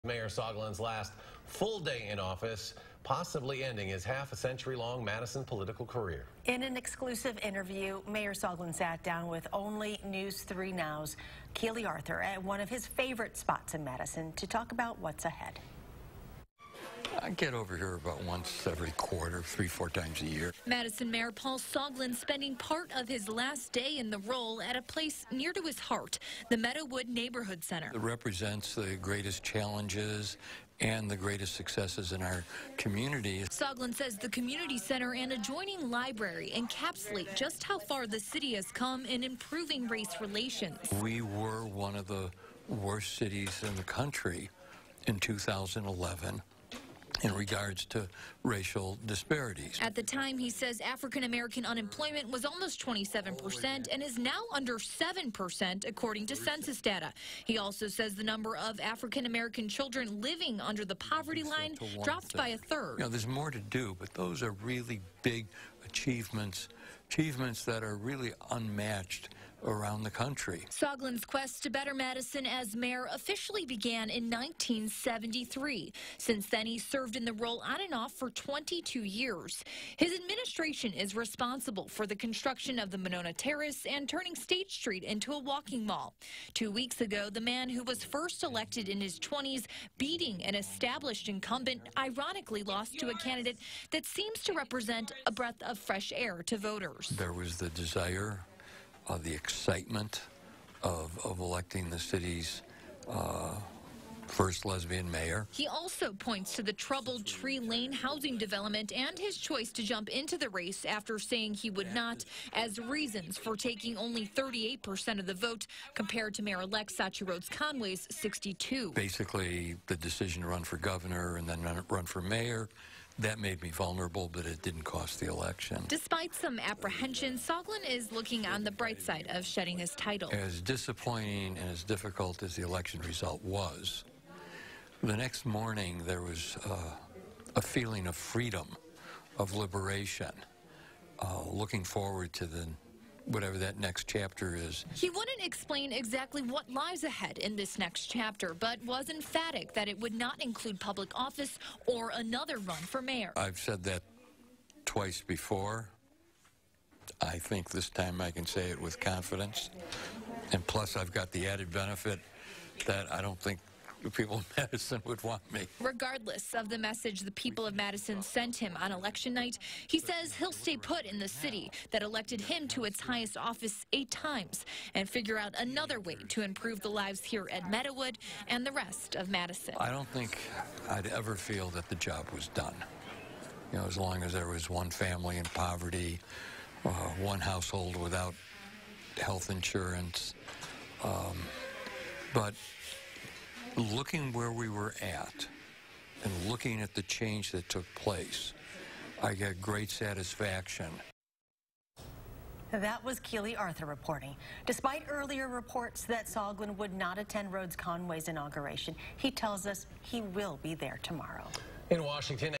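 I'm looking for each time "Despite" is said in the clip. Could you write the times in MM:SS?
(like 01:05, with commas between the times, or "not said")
02:05, 03:24.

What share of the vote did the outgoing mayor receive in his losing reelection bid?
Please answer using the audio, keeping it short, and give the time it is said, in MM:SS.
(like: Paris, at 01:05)
38%, at 01:54.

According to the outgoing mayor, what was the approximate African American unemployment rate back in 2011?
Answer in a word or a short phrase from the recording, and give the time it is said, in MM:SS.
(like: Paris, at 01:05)
27%, at 00:52.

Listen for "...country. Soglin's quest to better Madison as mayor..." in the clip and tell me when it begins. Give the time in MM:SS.
01:10.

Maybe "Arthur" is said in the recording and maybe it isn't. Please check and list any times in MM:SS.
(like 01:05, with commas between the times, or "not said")
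00:11, 03:23.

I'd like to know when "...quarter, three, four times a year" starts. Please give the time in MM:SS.
00:18.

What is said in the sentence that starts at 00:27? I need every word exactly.
It represents the greatest challenges and the greatest successes in our community.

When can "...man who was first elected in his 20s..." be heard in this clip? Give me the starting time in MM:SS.
01:27.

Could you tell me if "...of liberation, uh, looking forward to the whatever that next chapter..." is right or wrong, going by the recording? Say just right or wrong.
right.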